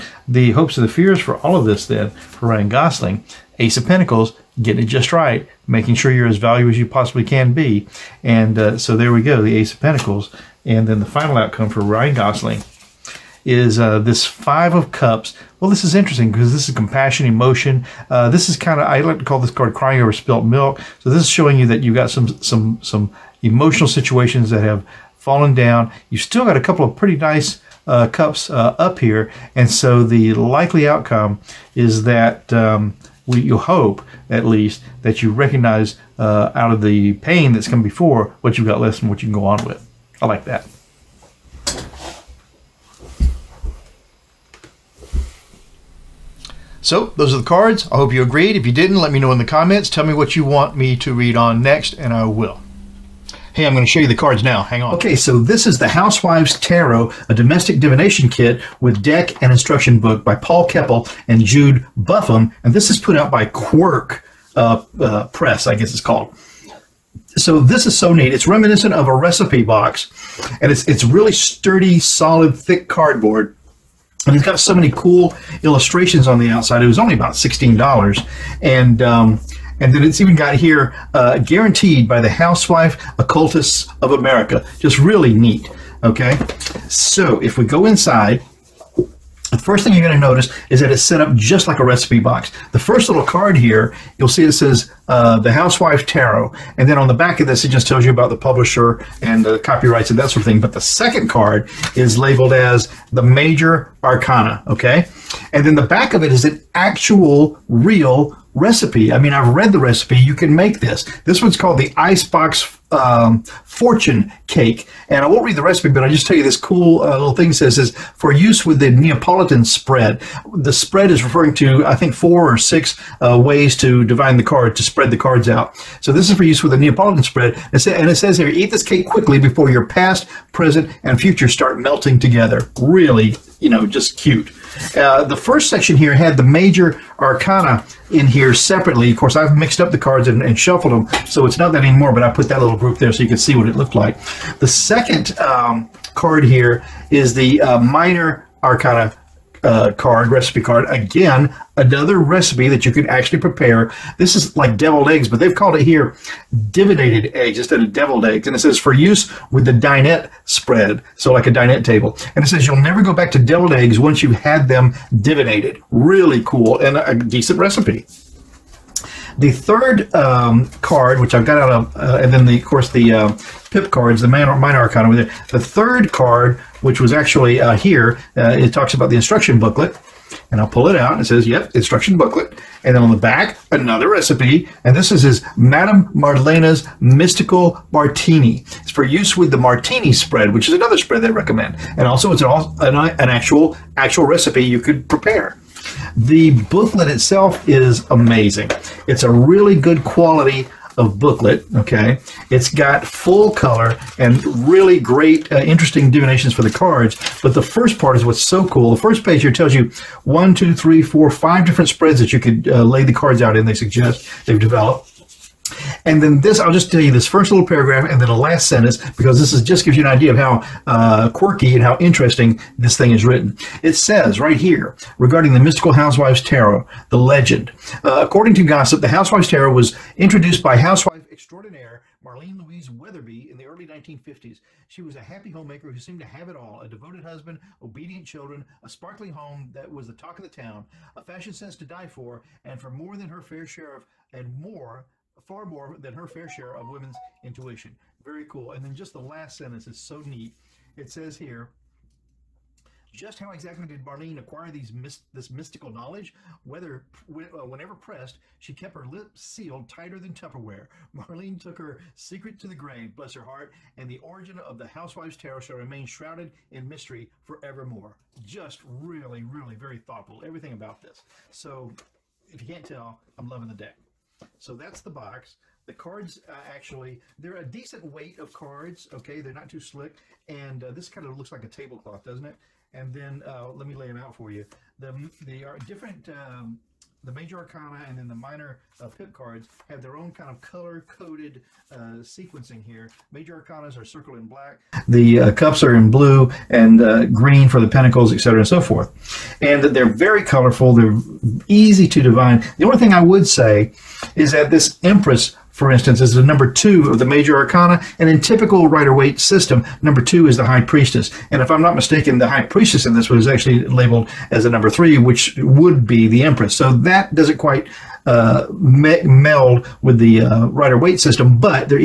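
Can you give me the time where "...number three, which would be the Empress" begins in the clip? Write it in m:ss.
5:14.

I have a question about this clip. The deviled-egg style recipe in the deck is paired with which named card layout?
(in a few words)
dinette spread.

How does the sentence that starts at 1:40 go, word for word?
But the second card is labeled as the Major Arcana.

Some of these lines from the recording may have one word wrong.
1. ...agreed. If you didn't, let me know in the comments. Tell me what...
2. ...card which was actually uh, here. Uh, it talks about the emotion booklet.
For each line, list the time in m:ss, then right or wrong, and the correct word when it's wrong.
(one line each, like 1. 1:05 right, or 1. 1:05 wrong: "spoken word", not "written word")
1. 0:48 right
2. 2:56 wrong: "instruction", not "emotion".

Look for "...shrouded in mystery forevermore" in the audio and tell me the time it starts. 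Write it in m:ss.
4:26.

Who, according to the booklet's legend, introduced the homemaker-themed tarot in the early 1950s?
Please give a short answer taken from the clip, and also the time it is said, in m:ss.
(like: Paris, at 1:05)
Marlene Louise Weatherby, at 3:52.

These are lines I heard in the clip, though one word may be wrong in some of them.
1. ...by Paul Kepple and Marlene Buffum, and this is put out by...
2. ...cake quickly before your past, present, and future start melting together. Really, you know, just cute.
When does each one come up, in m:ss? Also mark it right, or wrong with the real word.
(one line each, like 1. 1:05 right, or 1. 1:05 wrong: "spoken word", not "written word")
1. 1:00 wrong: "Jude", not "Marlene"
2. 2:08 right.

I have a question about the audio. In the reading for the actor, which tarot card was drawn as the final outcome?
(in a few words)
Five of Cups.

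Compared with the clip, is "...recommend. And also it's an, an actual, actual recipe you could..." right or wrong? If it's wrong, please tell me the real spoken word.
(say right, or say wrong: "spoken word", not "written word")
right.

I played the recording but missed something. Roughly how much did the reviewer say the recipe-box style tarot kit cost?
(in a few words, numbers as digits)
$16.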